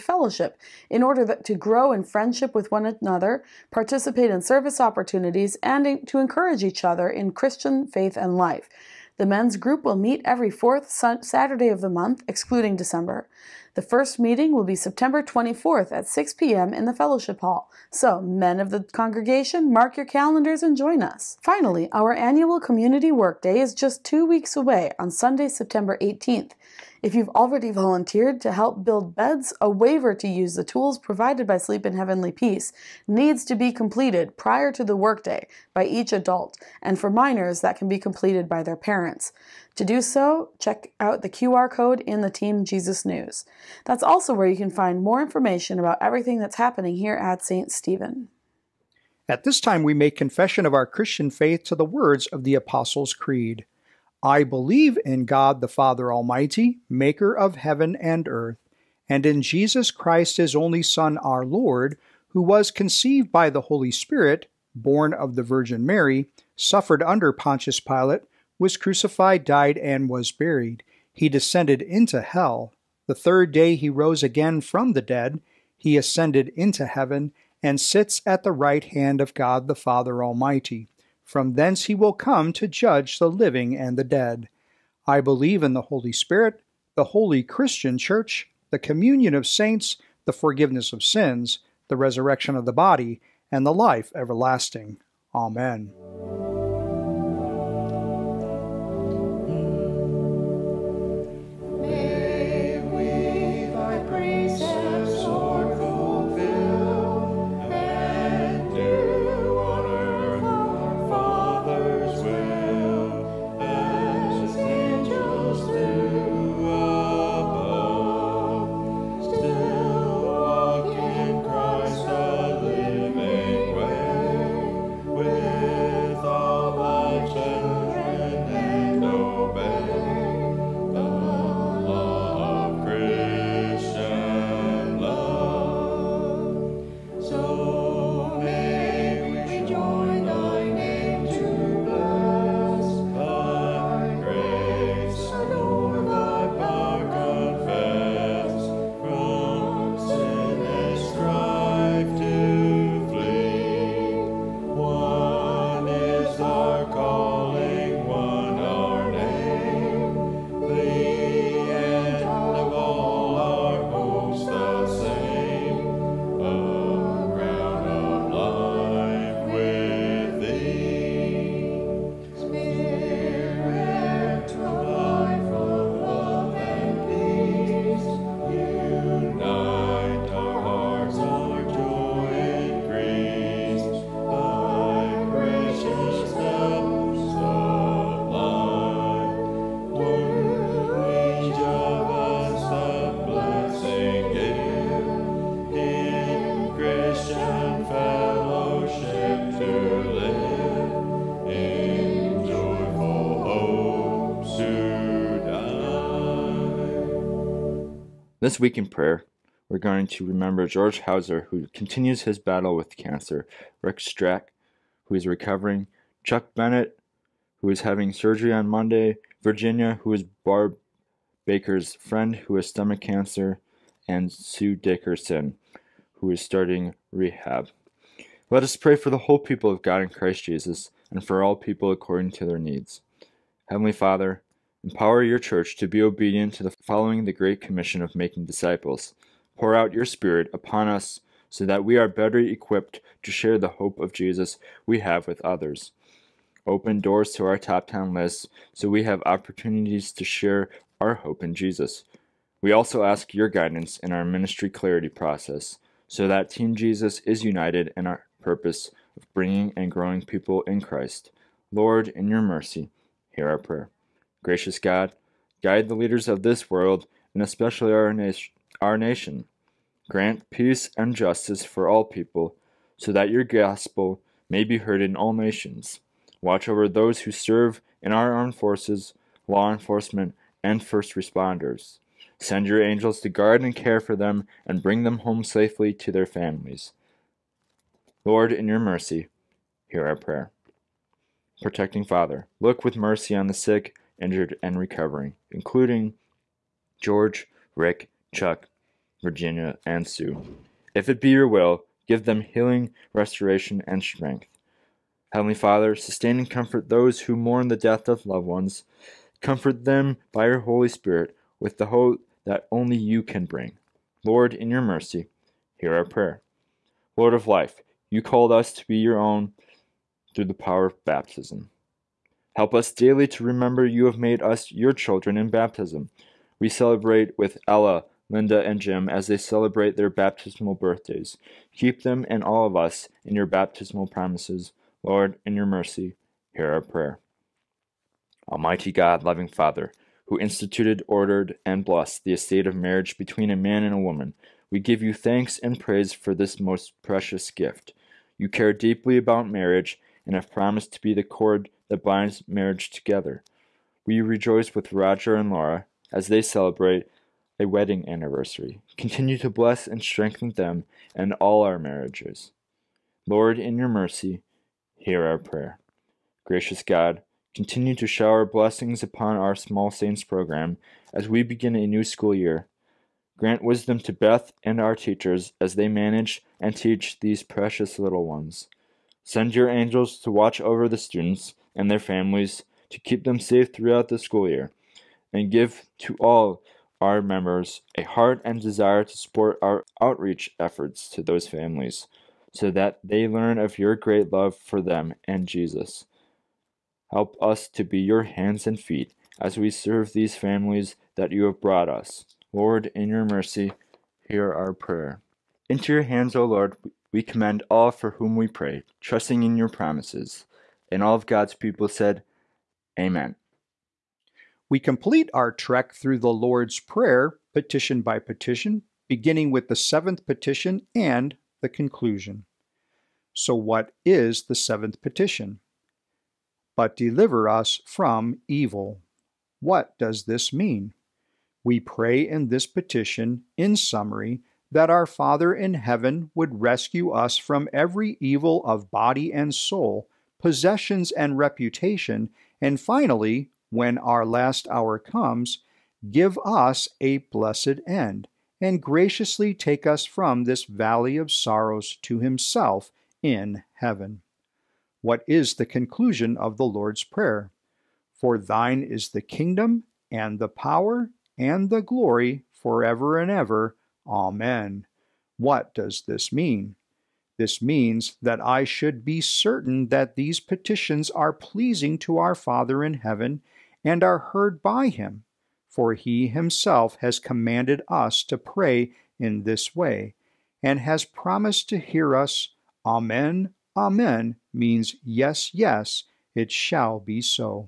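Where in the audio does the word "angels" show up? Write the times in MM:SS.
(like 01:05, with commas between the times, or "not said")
04:42, 06:19.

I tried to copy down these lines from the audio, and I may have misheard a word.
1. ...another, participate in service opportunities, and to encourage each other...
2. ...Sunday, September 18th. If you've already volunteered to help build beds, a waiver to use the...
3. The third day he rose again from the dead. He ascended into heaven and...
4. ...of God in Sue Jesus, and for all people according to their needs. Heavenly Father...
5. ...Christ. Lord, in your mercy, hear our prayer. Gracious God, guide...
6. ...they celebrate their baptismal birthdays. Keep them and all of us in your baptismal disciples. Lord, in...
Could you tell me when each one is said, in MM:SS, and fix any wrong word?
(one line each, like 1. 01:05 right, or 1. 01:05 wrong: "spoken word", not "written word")
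1. 00:02 right
2. 00:25 right
3. 01:13 right
4. 03:49 wrong: "Christ", not "Sue"
5. 04:20 right
6. 05:29 wrong: "promises", not "disciples".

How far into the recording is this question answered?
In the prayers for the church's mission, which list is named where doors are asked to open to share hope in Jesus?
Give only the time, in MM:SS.
04:07.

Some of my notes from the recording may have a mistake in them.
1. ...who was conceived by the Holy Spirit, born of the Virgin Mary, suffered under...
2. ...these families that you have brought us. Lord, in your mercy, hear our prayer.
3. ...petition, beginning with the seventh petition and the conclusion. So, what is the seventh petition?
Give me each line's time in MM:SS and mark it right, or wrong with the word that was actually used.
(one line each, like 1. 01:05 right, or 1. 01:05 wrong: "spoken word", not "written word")
1. 01:02 right
2. 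06:40 right
3. 06:58 right.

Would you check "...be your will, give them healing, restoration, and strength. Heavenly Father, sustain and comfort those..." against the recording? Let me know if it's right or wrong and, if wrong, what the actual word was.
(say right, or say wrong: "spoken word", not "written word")
right.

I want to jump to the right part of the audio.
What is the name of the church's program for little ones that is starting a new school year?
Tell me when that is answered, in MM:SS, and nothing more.
06:09.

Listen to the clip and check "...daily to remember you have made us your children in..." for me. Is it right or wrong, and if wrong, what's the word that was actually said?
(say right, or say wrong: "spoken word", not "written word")
right.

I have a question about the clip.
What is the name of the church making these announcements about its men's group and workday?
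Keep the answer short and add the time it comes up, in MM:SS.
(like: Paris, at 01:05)
St. Stephen, at 00:47.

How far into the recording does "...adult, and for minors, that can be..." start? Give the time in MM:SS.
00:36.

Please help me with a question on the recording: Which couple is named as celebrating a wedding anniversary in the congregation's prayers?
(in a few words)
Roger and Laura.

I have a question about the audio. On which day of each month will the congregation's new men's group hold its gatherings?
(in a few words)
Fourth Saturday.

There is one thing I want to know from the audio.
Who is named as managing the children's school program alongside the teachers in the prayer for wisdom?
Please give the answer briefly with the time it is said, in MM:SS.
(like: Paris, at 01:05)
Beth, at 06:14.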